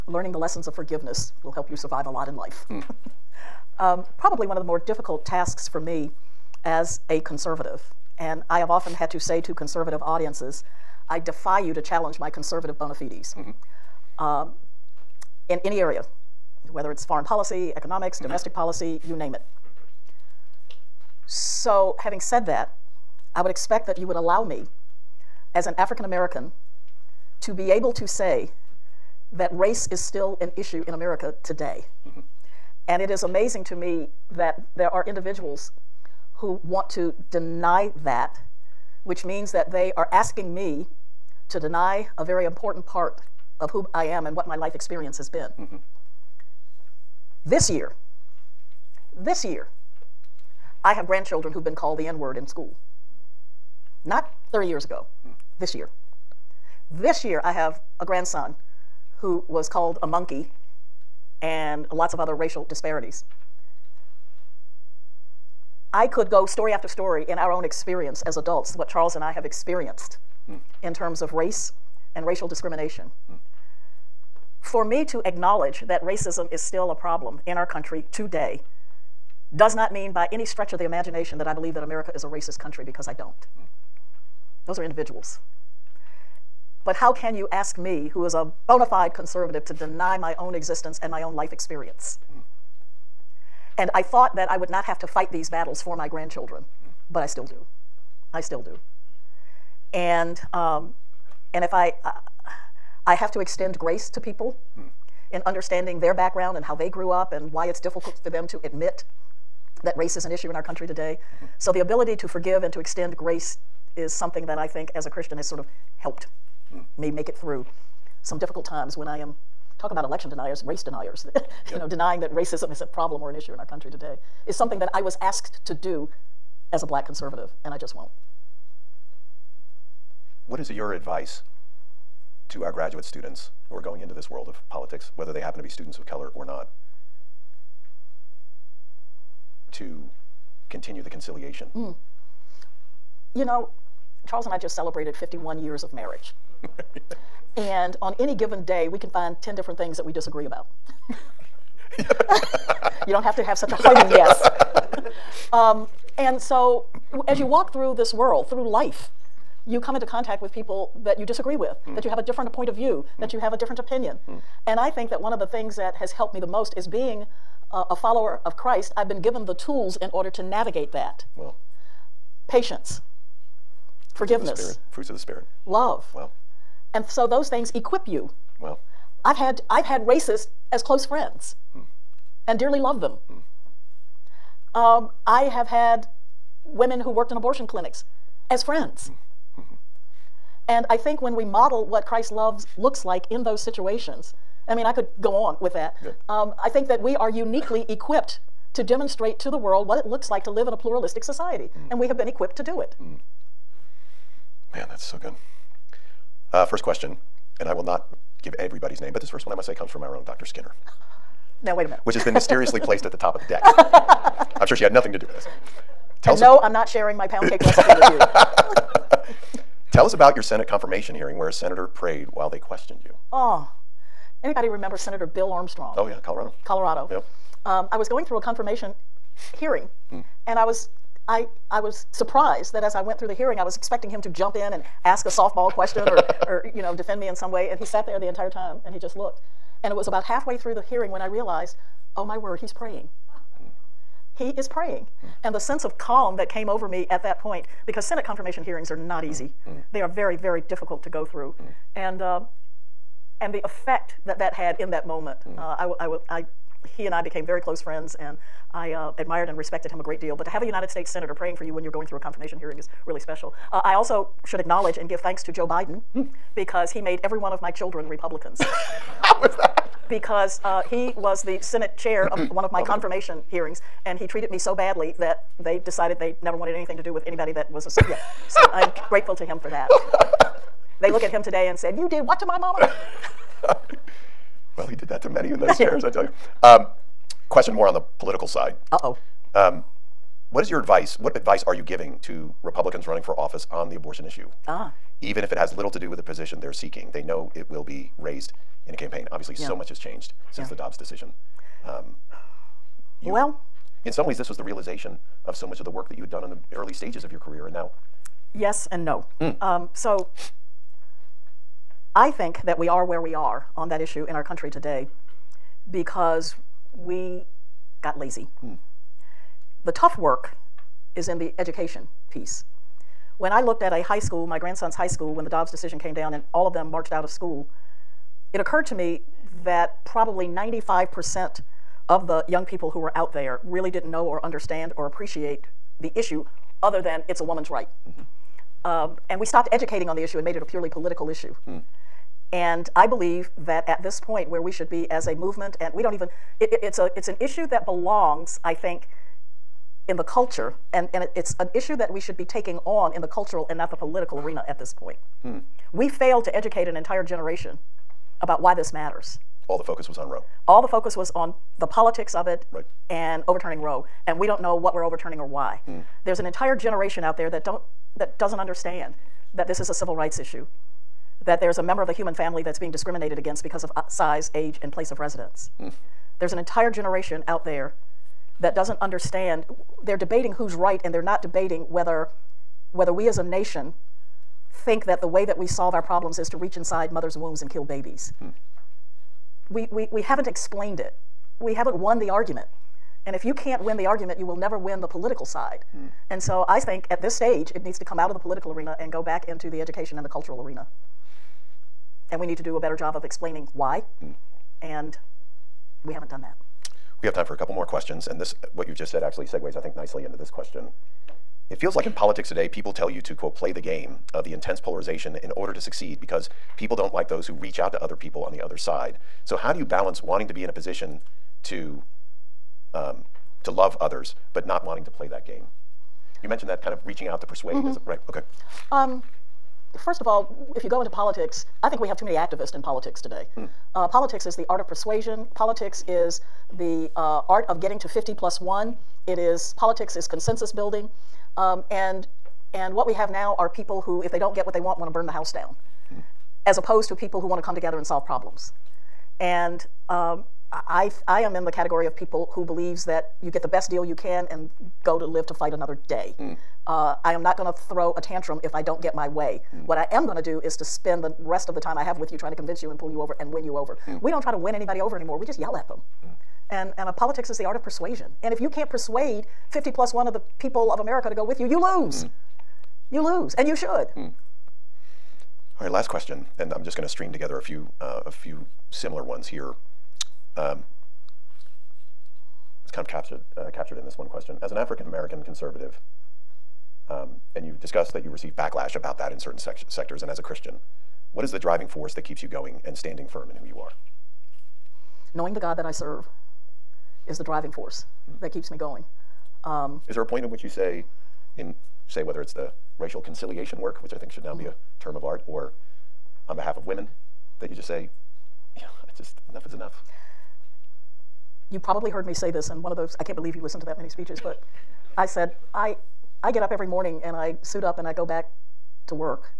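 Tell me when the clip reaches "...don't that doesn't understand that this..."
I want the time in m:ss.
6:07.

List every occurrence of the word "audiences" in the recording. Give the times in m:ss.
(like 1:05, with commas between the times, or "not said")
0:10.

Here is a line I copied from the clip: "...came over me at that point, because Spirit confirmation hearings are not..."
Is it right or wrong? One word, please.
wrong.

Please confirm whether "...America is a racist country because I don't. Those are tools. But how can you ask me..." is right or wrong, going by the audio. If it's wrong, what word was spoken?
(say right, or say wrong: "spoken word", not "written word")
wrong: "individuals", not "tools".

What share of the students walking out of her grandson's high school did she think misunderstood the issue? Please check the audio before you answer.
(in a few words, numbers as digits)
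95%.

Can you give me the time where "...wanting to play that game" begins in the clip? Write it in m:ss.
7:04.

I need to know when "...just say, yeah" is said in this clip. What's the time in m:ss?
8:27.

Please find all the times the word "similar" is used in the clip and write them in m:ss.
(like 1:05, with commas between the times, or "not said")
7:58.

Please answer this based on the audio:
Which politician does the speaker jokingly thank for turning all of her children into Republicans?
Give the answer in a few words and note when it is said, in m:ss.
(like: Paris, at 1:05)
Joe Biden, at 4:25.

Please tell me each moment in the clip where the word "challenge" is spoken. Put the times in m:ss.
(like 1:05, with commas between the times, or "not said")
0:11.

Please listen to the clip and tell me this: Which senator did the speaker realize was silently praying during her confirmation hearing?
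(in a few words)
Bill Armstrong.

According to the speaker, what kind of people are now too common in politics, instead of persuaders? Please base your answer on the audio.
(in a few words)
activists.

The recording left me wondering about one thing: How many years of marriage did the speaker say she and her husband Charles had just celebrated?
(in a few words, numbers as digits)
51.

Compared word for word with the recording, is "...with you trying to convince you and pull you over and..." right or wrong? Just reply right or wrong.
right.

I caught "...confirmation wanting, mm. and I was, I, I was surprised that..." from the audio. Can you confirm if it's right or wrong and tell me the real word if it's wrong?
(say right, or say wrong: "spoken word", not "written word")
wrong: "hearing", not "wanting".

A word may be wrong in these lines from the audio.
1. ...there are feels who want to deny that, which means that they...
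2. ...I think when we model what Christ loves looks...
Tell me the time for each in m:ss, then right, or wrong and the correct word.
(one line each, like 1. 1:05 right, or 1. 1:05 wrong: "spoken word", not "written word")
1. 0:34 wrong: "individuals", not "feels"
2. 3:10 right.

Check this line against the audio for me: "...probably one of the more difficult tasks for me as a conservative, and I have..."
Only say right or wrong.
right.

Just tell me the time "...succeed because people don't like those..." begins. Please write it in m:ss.
6:55.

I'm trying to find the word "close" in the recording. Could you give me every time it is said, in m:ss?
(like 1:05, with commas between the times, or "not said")
3:00, 4:17.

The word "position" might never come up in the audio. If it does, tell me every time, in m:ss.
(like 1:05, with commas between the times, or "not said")
4:56, 7:00.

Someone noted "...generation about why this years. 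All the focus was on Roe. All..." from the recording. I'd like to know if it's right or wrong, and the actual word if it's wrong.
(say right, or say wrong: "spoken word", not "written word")
wrong: "matters", not "years".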